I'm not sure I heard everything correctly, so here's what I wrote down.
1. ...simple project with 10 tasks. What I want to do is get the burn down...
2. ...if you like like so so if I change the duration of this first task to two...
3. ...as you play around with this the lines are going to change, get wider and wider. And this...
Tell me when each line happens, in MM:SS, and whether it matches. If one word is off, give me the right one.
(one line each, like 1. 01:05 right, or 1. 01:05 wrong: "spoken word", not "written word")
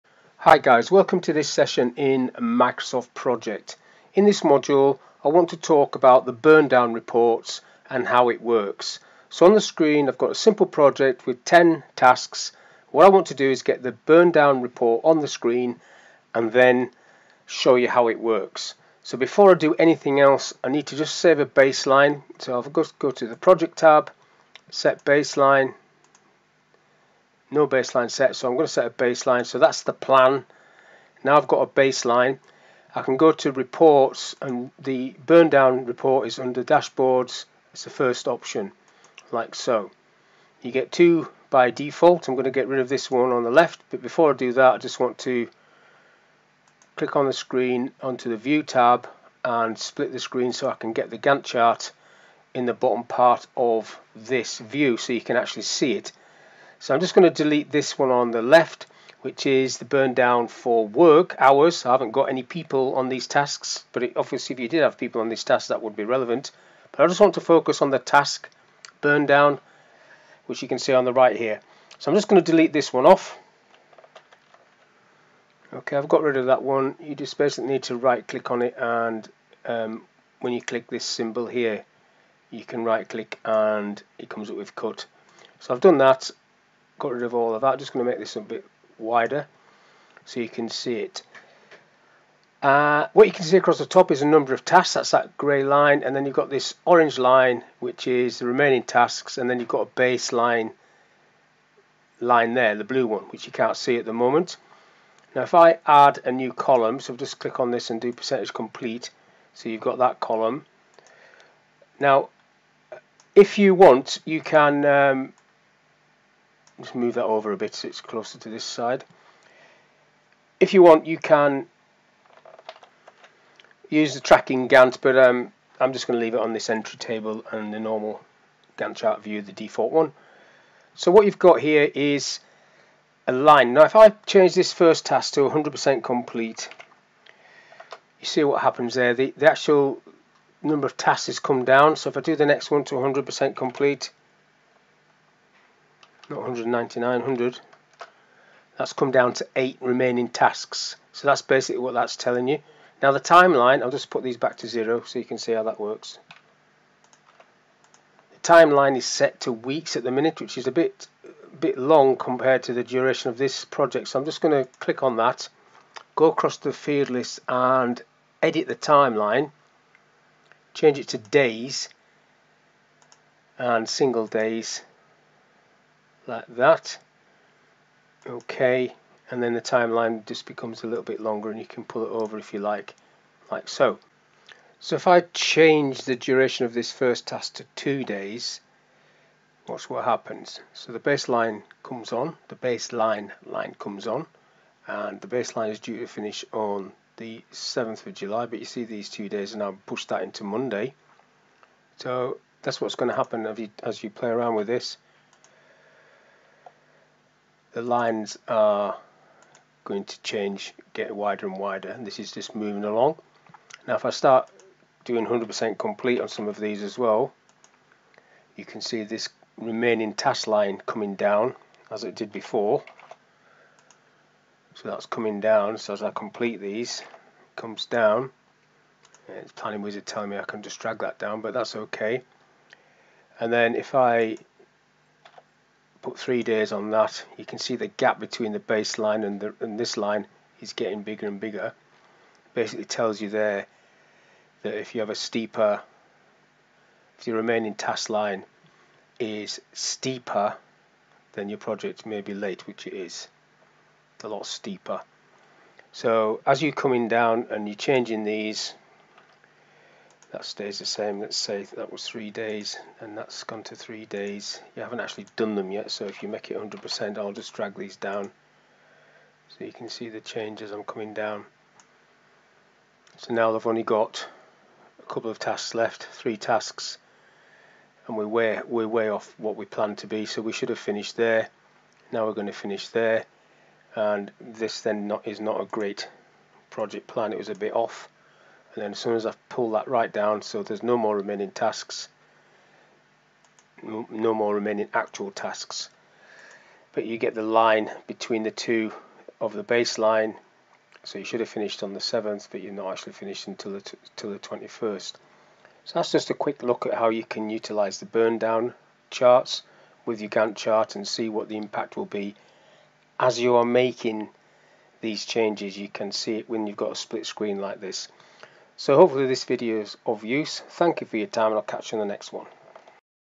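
1. 00:10 right
2. 03:02 right
3. 03:23 right.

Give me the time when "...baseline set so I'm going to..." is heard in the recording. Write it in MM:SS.
00:27.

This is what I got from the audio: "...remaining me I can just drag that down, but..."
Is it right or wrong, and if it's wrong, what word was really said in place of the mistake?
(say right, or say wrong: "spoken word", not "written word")
wrong: "telling", not "remaining".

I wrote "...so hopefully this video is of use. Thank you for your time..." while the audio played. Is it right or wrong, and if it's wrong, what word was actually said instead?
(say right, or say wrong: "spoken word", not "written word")
right.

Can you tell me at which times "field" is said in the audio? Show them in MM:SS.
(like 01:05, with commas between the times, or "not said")
02:46.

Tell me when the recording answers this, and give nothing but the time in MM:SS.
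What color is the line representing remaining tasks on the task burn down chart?
01:36.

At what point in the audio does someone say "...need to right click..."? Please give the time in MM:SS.
01:17.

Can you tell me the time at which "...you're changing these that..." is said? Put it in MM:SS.
04:17.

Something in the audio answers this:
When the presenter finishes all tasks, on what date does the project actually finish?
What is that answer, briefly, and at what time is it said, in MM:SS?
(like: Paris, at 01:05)
the 21st, at 05:04.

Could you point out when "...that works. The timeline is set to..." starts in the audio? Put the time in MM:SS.
02:35.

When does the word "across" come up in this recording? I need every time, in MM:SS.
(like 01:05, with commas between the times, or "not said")
01:33, 02:46.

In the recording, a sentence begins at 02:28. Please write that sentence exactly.
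That's come down to eight remaining tasks.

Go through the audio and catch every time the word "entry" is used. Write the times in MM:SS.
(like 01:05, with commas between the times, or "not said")
02:06.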